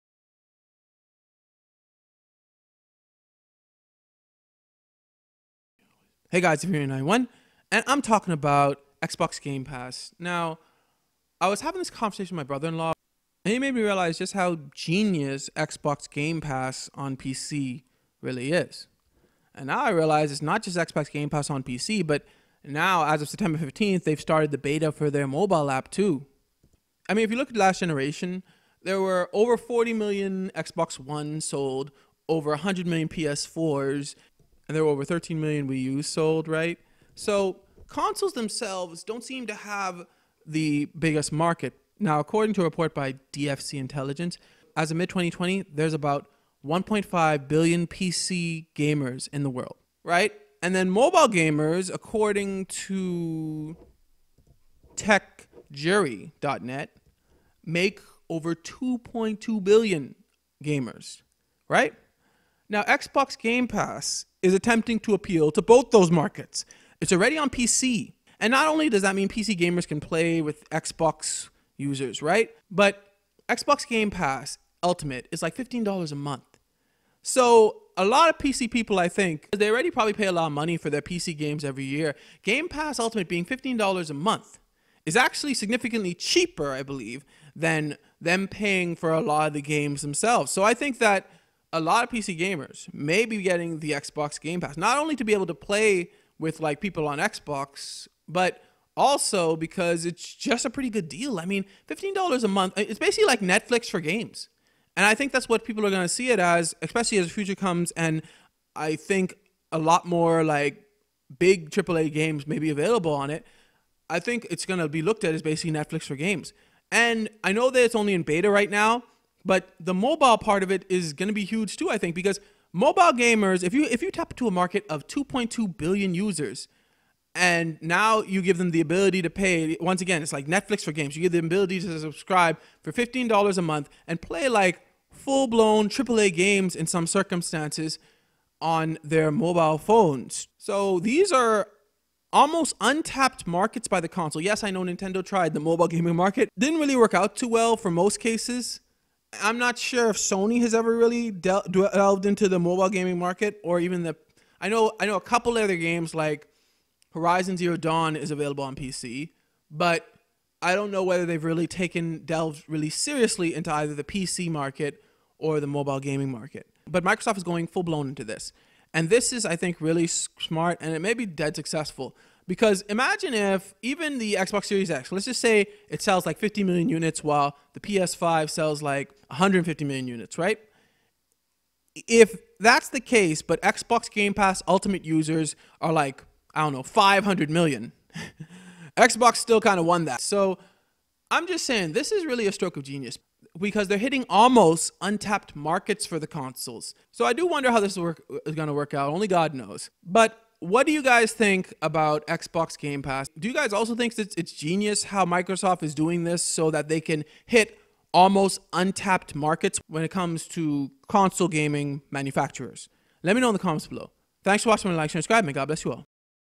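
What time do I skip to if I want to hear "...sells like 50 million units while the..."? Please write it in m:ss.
2:56.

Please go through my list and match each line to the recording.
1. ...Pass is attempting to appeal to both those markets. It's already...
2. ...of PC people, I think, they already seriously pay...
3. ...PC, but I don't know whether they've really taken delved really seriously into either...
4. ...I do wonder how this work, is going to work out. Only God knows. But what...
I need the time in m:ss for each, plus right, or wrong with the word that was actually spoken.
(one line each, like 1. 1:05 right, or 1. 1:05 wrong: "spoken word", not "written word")
1. 1:03 right
2. 1:18 wrong: "probably", not "seriously"
3. 2:38 right
4. 3:17 right.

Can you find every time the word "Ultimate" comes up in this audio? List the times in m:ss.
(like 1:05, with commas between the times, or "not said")
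1:14, 1:22, 3:04.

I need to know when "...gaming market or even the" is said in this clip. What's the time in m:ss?
2:32.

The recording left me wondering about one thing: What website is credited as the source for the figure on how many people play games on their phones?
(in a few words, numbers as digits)
techjury.net.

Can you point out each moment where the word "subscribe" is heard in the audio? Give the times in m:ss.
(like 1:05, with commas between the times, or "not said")
2:11, 3:35.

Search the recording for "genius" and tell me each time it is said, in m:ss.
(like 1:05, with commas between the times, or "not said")
0:14, 3:12, 3:24.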